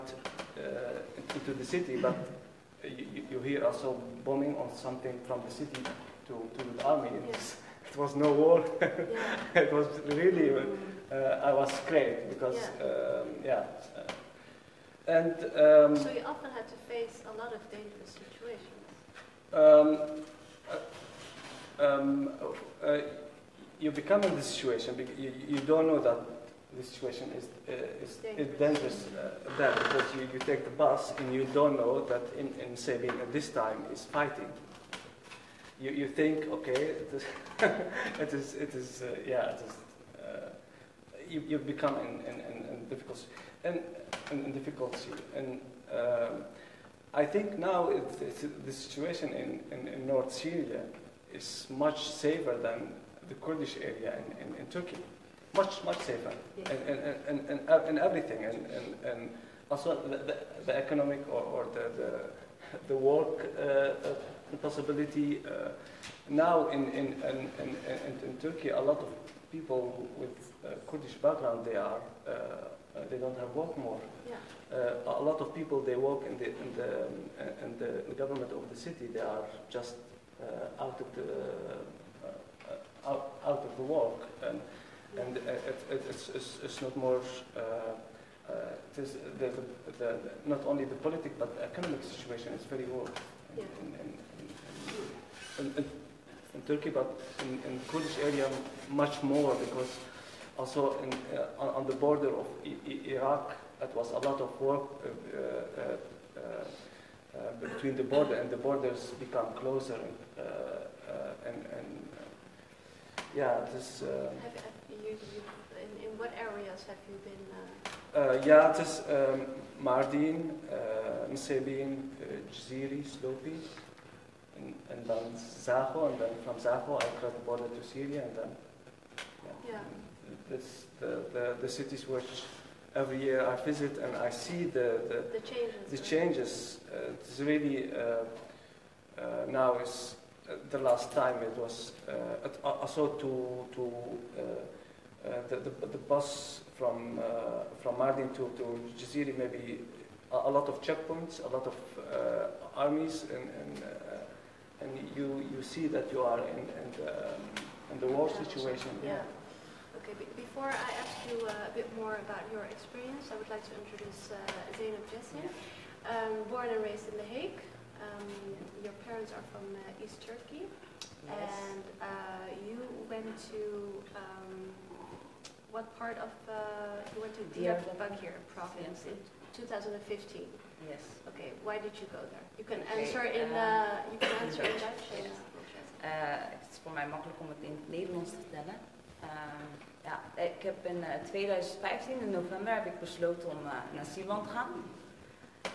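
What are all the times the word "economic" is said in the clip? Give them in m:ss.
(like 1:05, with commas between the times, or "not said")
1:00, 1:31.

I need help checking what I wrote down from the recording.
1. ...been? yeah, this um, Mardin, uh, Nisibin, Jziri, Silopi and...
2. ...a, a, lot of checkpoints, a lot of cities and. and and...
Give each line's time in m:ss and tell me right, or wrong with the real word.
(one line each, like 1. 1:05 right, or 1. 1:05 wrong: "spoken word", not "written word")
1. 1:57 right
2. 2:30 wrong: "armies", not "cities".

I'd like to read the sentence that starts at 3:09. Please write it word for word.
Ehm, ja, ik heb in 2015 eh, in november heb ik besloten om eh, naar Zeeland te gaan.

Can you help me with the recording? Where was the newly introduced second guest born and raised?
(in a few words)
The Hague.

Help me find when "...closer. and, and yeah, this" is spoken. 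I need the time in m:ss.
1:49.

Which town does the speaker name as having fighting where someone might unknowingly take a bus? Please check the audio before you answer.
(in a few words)
Sabine.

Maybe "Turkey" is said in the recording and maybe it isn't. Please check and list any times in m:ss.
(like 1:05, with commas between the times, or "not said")
0:54, 1:08, 1:36, 2:50.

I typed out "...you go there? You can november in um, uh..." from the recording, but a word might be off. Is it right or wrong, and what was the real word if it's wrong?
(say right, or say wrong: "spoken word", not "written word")
wrong: "answer", not "november".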